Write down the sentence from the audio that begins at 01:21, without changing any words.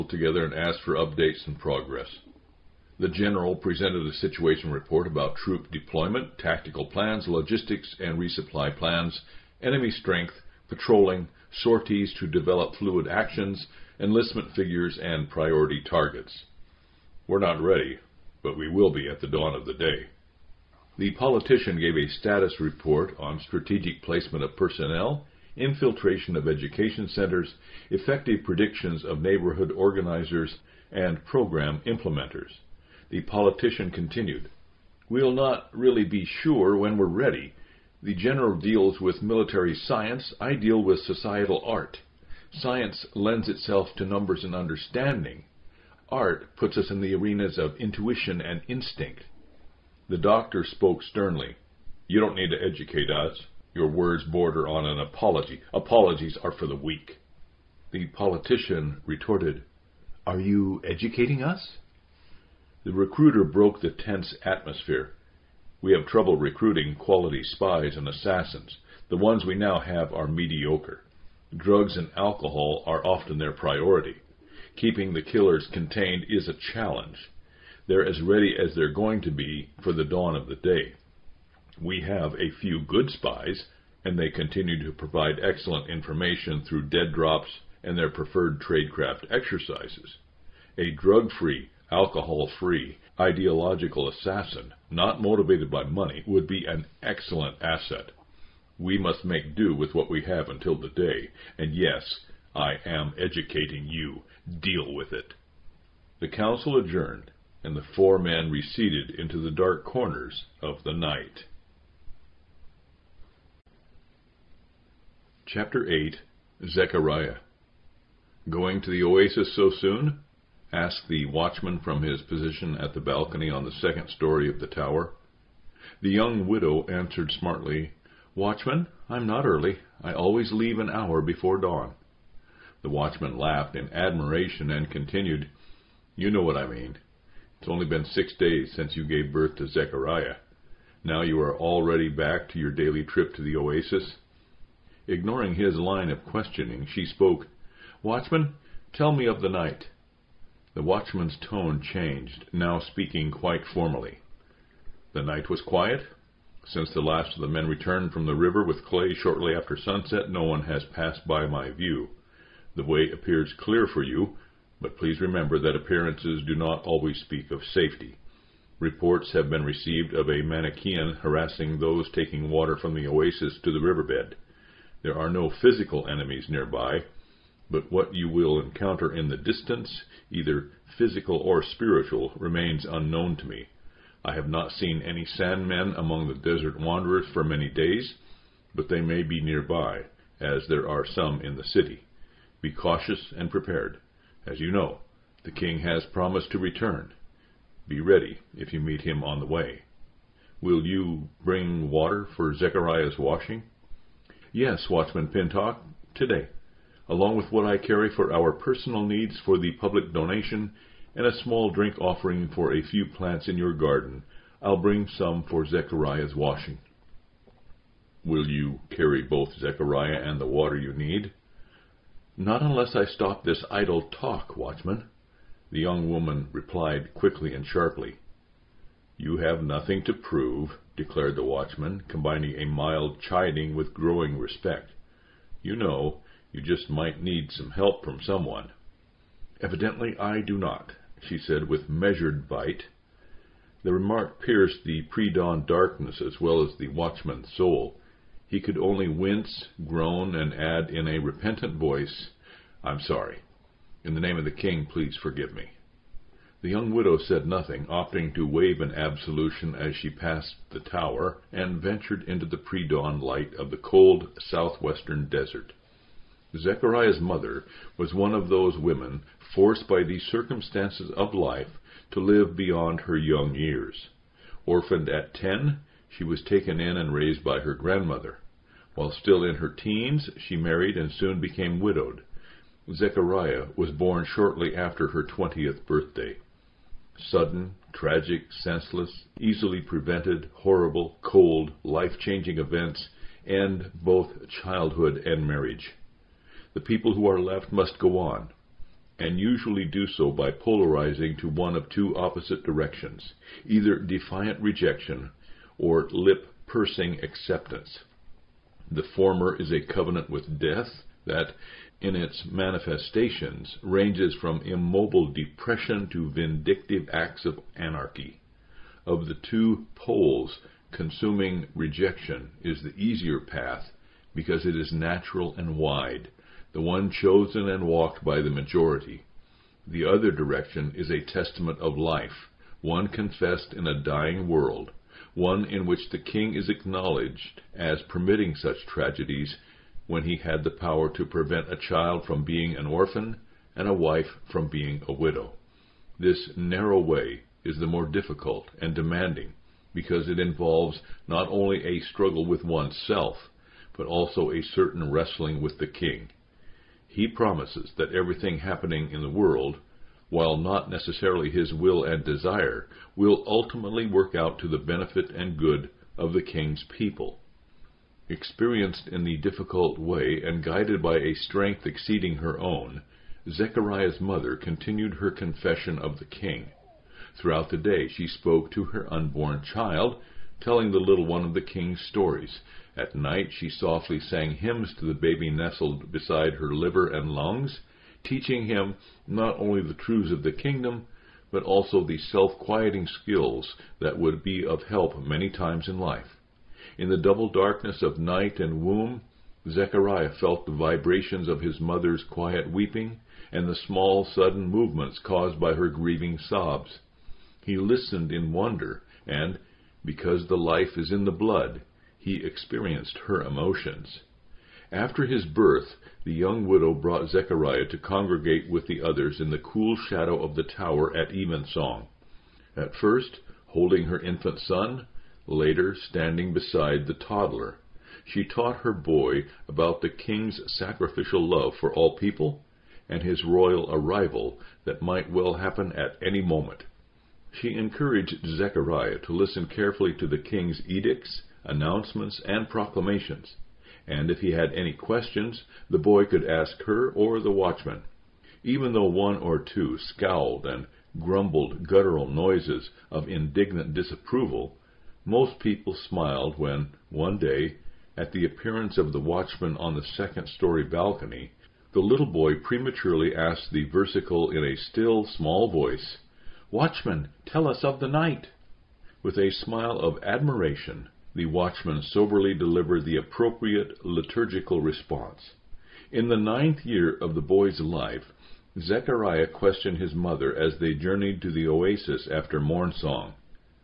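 We have a few good spies, and they continue to provide excellent information through dead drops and their preferred tradecraft exercises.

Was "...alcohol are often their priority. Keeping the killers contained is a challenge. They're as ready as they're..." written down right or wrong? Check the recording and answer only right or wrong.
right.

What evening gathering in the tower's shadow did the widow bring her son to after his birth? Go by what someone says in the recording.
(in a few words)
Evensong.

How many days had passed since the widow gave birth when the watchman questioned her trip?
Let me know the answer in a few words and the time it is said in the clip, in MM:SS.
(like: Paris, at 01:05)
6, at 02:18.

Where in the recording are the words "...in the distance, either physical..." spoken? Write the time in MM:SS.
02:59.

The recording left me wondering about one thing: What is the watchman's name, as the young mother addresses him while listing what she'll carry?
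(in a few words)
Pintock.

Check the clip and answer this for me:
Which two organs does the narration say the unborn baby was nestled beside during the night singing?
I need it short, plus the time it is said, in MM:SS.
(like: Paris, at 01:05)
Liver and lungs, at 06:26.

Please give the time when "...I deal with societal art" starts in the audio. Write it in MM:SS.
00:40.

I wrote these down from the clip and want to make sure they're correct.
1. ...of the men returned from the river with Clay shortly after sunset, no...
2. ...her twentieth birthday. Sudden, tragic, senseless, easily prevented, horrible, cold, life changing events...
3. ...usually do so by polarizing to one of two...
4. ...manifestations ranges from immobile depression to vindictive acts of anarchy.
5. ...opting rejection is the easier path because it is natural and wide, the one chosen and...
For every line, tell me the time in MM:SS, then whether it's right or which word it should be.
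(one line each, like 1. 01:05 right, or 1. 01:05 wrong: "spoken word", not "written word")
1. 02:37 right
2. 04:45 right
3. 04:59 right
4. 05:12 right
5. 05:20 wrong: "consuming", not "opting".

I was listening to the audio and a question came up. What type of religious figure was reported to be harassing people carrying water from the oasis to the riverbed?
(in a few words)
Manichean.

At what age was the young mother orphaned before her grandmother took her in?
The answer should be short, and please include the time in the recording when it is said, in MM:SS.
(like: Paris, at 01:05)
10, at 04:35.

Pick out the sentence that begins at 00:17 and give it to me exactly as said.
We're not ready, but we will be at the dawn of the day.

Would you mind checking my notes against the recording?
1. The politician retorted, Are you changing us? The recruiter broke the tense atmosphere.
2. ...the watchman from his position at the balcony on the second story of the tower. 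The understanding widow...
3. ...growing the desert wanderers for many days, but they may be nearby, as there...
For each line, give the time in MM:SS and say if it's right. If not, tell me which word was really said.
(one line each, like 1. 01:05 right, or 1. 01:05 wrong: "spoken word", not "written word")
1. 00:57 wrong: "educating", not "changing"
2. 02:01 wrong: "young", not "understanding"
3. 03:05 wrong: "among", not "growing".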